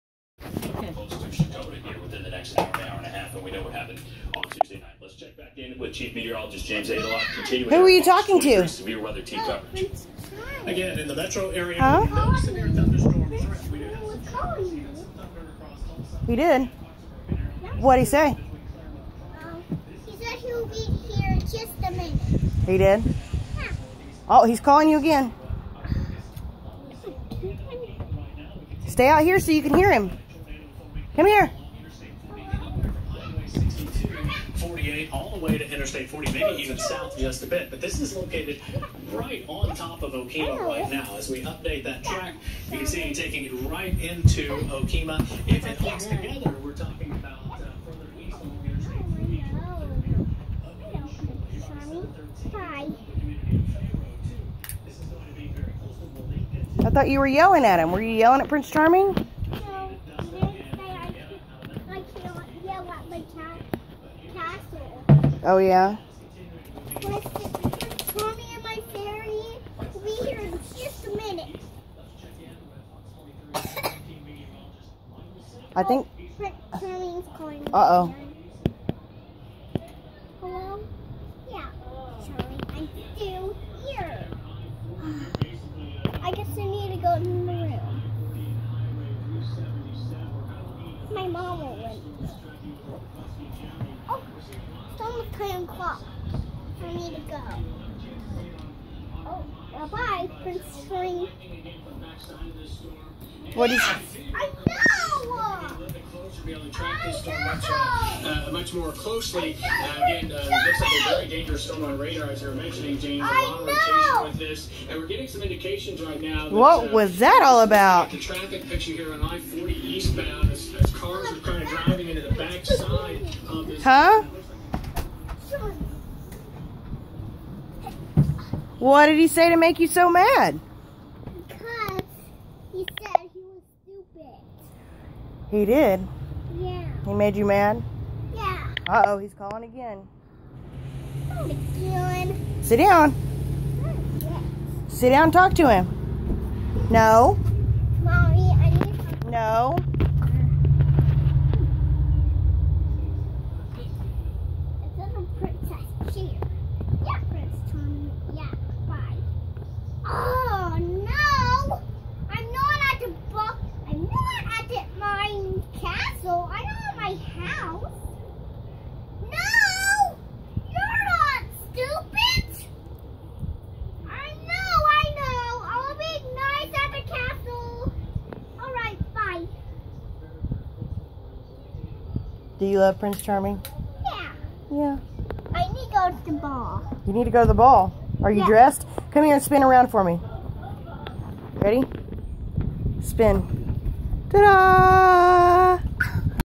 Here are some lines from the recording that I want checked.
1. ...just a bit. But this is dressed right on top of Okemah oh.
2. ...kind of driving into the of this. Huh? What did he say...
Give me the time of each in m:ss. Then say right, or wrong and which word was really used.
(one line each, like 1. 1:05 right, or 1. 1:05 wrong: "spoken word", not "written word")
1. 0:37 wrong: "located", not "dressed"
2. 2:01 right.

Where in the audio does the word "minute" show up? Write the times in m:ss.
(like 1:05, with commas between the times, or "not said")
0:21, 1:11.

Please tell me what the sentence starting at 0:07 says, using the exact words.
Continuing Who are you talking to?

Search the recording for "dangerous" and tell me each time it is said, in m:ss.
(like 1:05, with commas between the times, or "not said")
1:51.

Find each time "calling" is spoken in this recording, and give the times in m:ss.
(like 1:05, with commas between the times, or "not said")
0:24, 2:19.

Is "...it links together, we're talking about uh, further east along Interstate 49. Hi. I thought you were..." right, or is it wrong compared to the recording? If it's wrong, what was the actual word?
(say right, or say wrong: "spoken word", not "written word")
wrong: "40", not "49".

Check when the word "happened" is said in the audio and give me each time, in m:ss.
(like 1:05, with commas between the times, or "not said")
0:03.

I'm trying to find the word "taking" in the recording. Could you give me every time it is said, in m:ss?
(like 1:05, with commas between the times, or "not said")
0:43.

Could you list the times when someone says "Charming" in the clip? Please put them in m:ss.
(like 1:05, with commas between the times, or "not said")
0:58, 3:03.